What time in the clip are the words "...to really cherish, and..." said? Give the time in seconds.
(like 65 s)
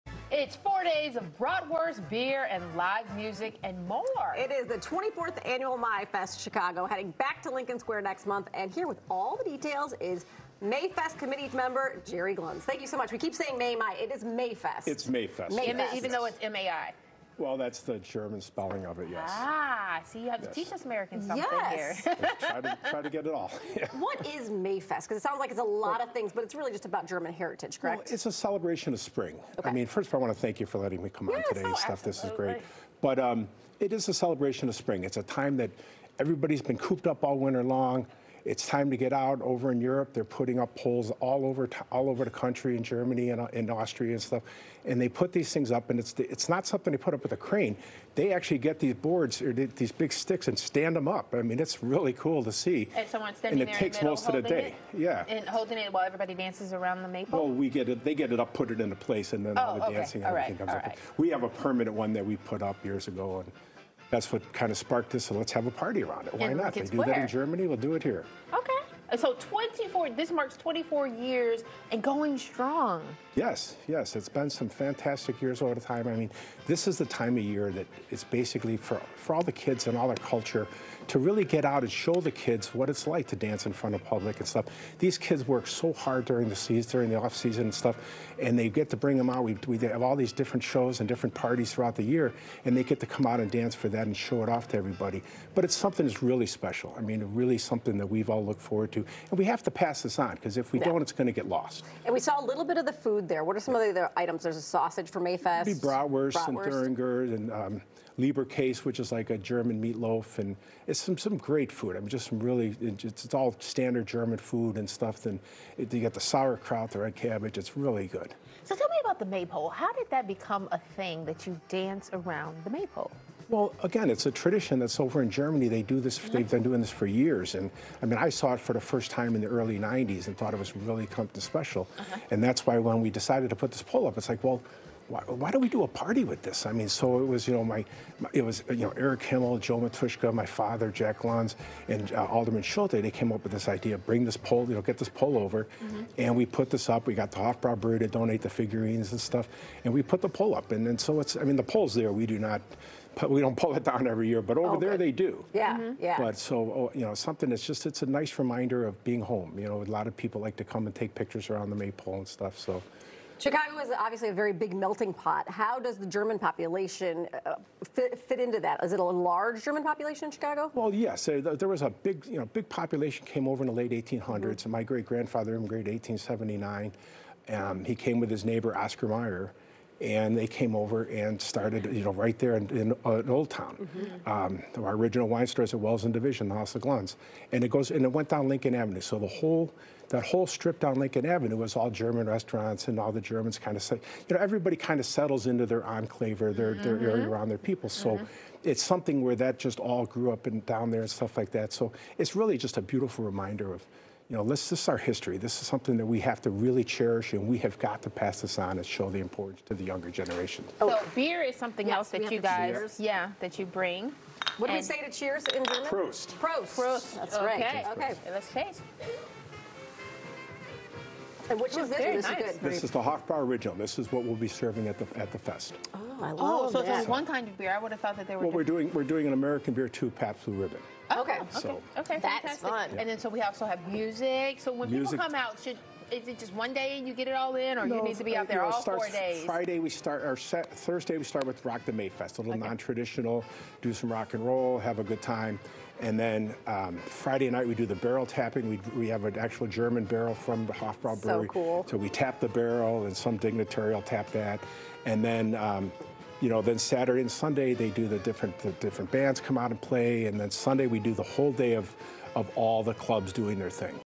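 206 s.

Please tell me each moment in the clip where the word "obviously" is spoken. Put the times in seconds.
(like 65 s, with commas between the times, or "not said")
163 s.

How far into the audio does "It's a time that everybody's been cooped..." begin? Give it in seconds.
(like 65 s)
35 s.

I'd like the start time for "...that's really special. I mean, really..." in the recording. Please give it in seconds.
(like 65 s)
96 s.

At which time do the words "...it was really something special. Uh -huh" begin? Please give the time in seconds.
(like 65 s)
130 s.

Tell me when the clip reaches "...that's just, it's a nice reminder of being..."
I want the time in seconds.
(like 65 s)
157 s.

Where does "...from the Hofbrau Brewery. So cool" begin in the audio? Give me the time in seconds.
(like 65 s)
250 s.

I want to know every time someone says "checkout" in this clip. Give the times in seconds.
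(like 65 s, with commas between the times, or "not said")
not said.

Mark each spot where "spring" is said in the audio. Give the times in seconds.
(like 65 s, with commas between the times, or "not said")
28 s, 34 s.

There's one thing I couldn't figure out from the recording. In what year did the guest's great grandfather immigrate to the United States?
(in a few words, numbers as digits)
1879.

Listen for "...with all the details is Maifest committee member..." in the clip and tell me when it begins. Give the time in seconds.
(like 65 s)
8 s.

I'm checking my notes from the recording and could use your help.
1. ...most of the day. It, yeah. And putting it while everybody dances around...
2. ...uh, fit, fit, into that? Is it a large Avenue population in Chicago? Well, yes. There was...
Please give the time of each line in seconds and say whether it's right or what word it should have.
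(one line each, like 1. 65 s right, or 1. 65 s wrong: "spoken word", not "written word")
1. 54 s wrong: "holding", not "putting"
2. 167 s wrong: "German", not "Avenue".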